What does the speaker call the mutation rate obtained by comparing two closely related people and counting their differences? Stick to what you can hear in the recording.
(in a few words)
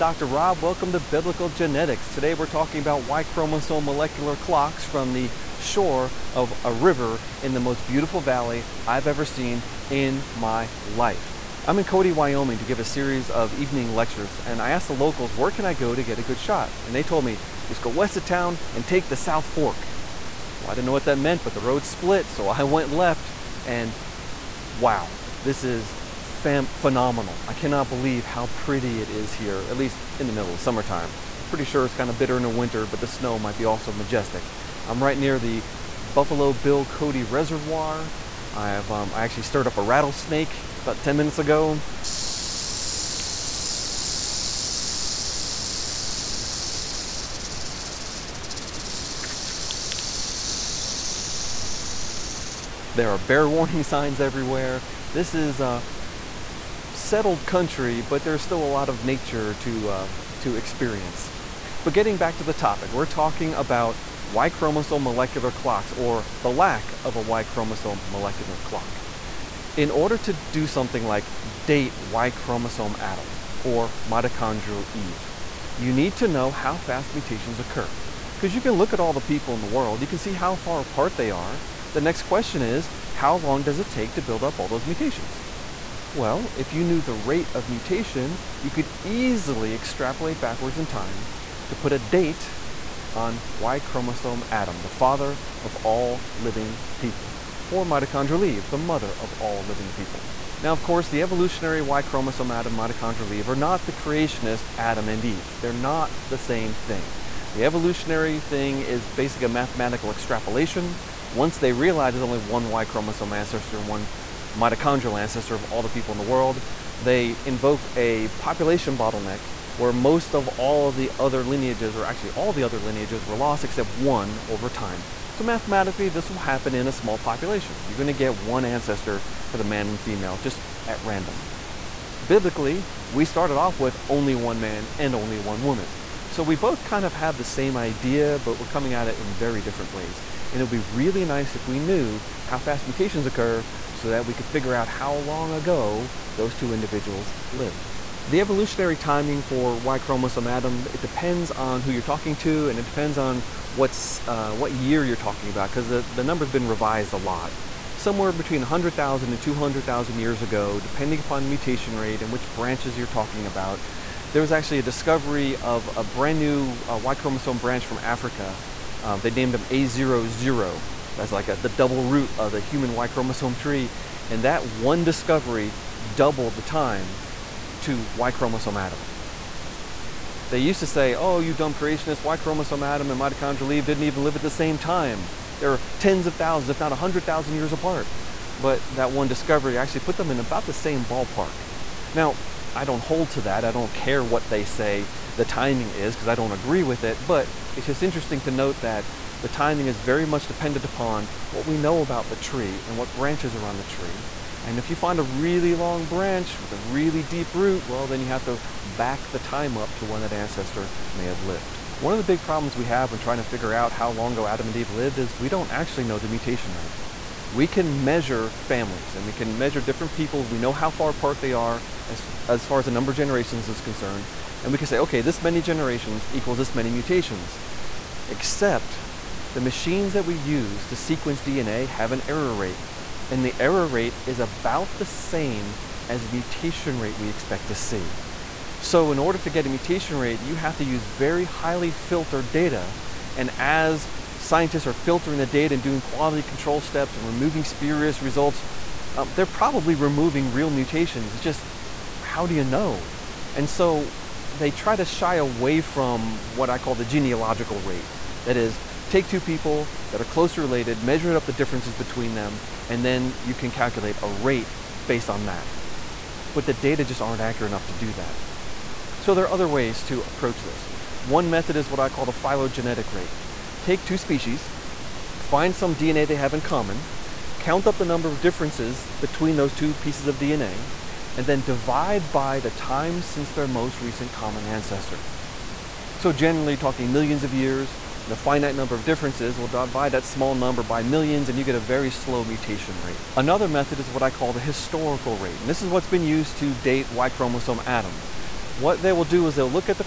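Genealogical rate.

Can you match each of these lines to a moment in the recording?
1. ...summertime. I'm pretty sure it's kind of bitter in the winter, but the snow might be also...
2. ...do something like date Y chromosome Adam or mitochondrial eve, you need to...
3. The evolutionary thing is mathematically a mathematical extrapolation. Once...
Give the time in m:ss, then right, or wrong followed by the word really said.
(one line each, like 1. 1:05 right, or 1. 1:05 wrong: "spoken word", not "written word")
1. 0:30 right
2. 1:10 right
3. 1:47 wrong: "basically", not "mathematically".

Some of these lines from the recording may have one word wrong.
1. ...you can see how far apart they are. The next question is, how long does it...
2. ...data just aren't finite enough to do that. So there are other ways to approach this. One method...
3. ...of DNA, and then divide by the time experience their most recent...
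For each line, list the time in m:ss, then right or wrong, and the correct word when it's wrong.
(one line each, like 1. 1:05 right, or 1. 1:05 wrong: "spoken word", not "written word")
1. 1:20 right
2. 4:26 wrong: "accurate", not "finite"
3. 4:40 wrong: "since", not "experience".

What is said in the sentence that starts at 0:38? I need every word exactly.
I, have, um, I actually stirred up a rattlesnake about 10 minutes ago.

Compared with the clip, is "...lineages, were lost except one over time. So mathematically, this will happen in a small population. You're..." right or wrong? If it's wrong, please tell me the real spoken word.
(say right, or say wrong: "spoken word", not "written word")
right.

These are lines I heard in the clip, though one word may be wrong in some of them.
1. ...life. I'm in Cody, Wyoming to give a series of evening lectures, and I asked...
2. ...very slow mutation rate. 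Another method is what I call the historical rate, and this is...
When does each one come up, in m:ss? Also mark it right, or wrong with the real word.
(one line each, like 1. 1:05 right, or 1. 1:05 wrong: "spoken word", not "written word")
1. 0:10 right
2. 4:51 right.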